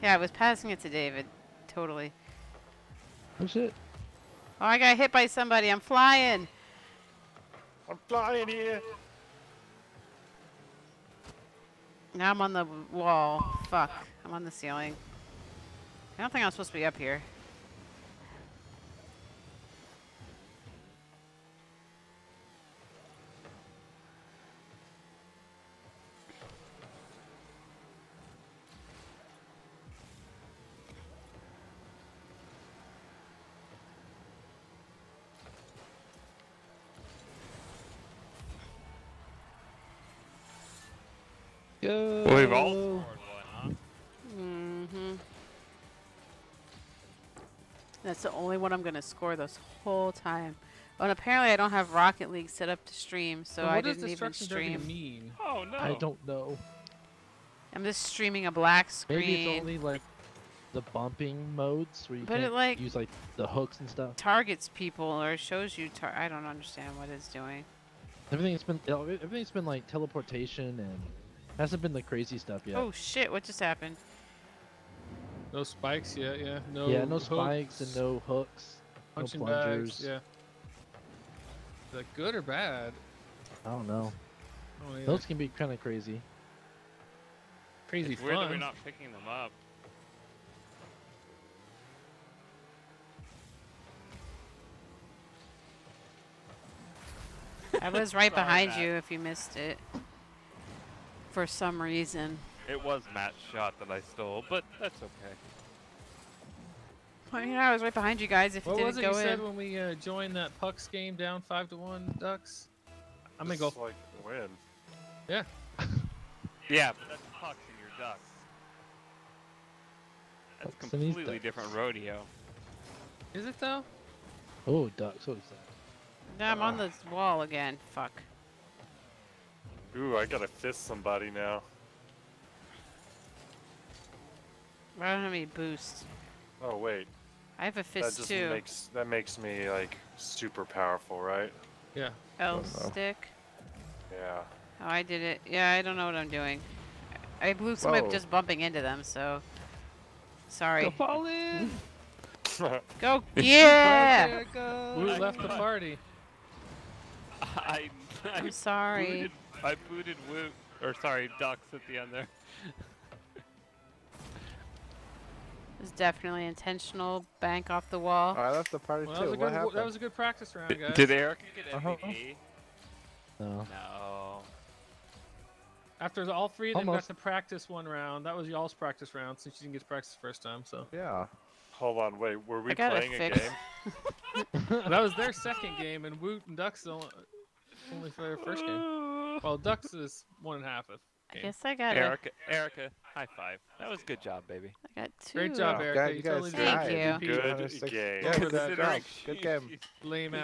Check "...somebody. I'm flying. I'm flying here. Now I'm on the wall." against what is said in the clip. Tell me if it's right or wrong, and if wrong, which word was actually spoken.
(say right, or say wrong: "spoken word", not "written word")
right.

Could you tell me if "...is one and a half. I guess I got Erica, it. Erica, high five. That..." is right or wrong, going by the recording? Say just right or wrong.
right.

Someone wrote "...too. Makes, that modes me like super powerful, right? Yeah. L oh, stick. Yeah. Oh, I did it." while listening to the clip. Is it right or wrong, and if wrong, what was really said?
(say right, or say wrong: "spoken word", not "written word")
wrong: "makes", not "modes".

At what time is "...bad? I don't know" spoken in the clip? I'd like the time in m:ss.
1:22.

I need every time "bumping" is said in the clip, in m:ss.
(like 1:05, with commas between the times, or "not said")
1:00, 2:28.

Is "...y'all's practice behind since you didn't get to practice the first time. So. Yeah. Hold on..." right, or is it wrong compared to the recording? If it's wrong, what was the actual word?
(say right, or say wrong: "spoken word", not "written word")
wrong: "round", not "behind".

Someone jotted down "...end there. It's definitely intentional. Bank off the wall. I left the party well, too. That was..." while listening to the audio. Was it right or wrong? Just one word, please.
right.